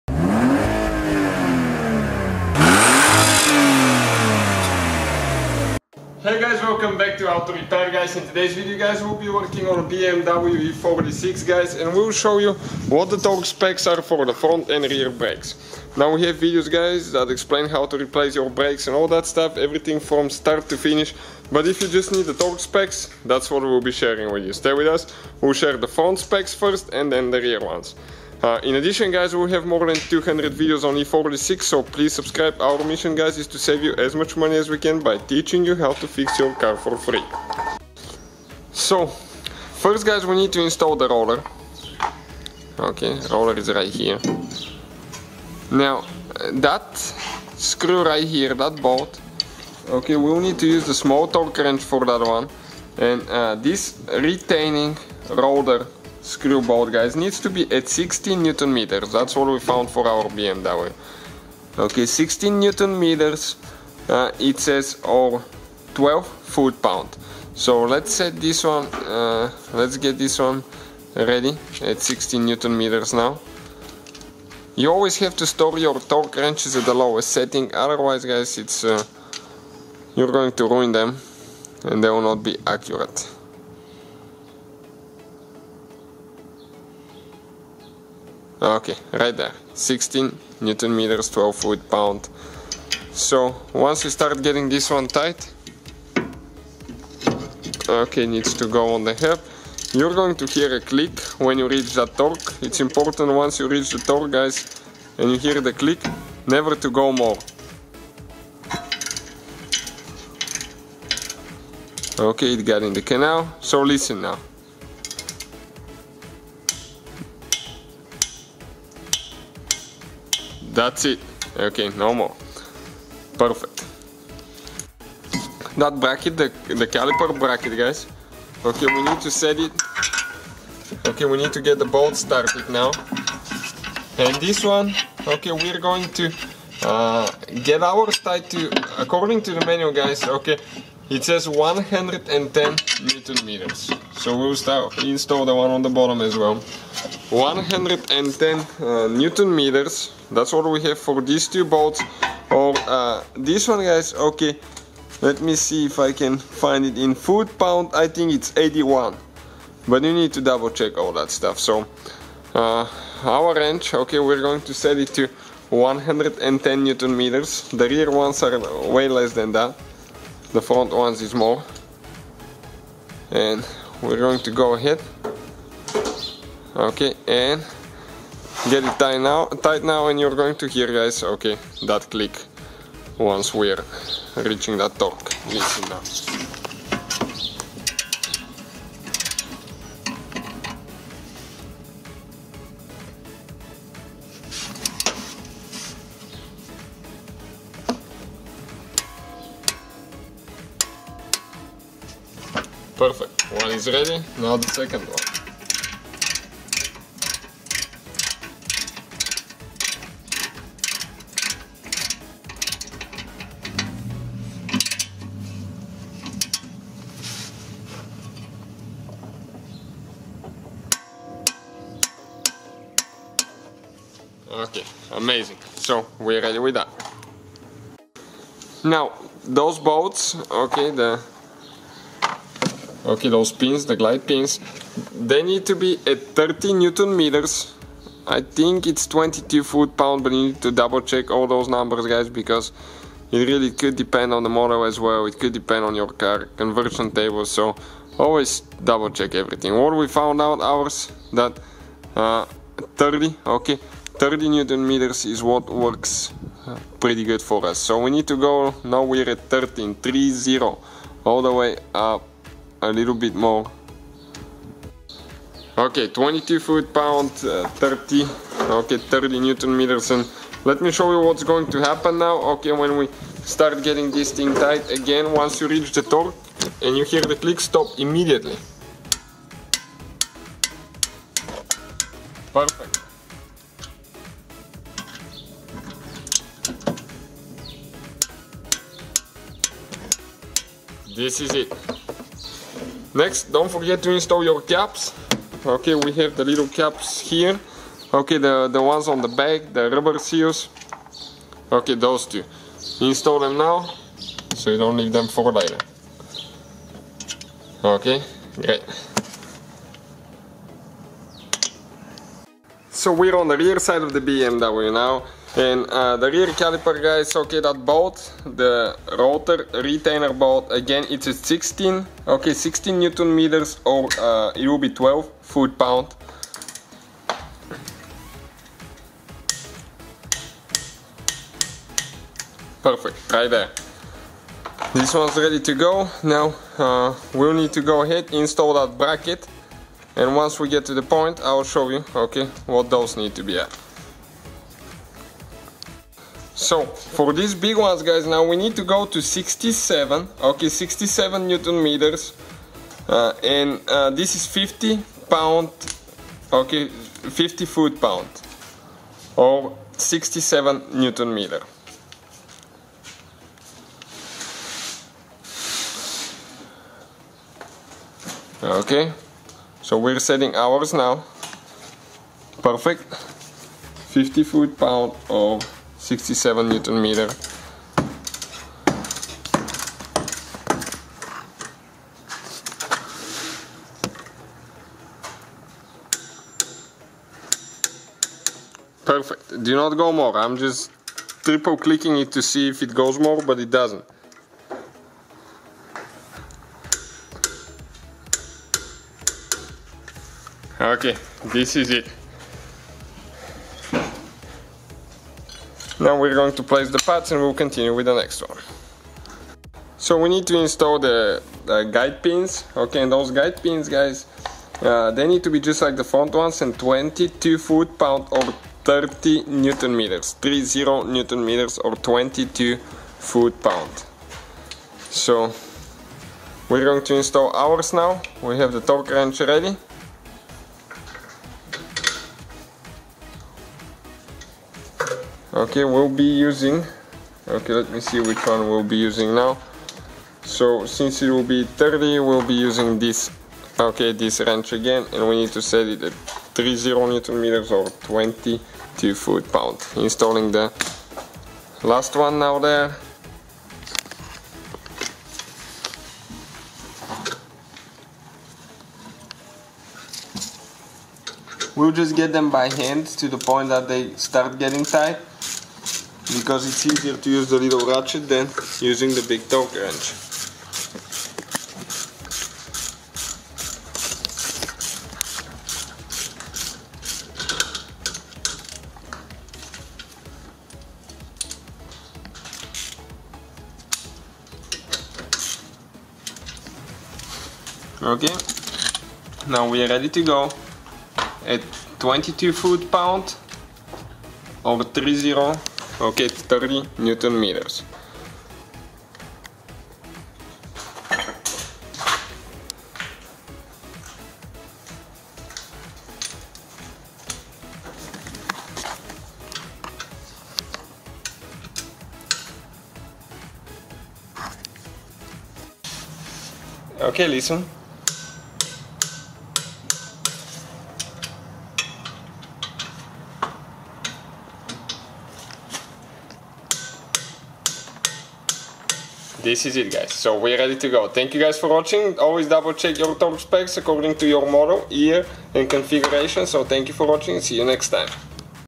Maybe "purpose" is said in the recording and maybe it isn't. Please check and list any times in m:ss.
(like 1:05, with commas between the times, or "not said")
not said.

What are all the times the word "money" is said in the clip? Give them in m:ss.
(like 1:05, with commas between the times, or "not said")
0:34.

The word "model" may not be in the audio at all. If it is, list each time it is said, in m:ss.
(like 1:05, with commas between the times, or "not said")
4:04, 8:54.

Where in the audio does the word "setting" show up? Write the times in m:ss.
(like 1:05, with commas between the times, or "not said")
1:17, 6:10.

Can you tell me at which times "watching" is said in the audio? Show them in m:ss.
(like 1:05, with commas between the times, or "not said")
8:51, 8:57.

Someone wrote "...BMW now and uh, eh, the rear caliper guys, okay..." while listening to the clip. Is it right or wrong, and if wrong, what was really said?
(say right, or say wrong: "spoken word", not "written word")
right.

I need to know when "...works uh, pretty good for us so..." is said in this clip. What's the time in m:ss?
4:15.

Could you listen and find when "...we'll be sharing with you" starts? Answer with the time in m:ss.
0:23.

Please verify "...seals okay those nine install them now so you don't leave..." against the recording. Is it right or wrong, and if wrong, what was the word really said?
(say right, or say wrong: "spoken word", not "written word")
wrong: "two", not "nine".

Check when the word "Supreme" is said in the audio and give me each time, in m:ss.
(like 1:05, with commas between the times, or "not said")
not said.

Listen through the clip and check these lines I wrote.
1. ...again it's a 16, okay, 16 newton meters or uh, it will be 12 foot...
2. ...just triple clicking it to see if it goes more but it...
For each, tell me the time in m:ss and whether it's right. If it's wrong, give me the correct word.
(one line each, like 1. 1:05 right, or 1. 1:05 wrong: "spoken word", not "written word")
1. 5:20 right
2. 6:30 right.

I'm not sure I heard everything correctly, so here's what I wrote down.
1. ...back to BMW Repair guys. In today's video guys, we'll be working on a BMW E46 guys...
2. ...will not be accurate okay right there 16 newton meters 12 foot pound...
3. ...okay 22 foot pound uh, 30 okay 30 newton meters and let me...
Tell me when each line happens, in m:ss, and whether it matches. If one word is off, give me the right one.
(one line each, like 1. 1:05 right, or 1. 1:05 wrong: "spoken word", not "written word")
1. 0:06 wrong: "Auto", not "BMW"
2. 1:22 right
3. 4:25 right.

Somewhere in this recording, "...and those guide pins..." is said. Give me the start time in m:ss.
6:53.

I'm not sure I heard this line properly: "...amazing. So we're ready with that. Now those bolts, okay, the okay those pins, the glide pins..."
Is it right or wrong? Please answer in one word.
right.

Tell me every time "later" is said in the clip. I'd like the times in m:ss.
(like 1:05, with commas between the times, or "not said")
5:05.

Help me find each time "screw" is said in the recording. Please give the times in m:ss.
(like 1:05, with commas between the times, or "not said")
0:47, 0:56.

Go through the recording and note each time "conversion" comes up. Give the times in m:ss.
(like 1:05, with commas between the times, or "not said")
4:06.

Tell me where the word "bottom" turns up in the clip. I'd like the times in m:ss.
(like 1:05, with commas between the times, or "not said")
2:25.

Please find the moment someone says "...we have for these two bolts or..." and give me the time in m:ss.
2:30.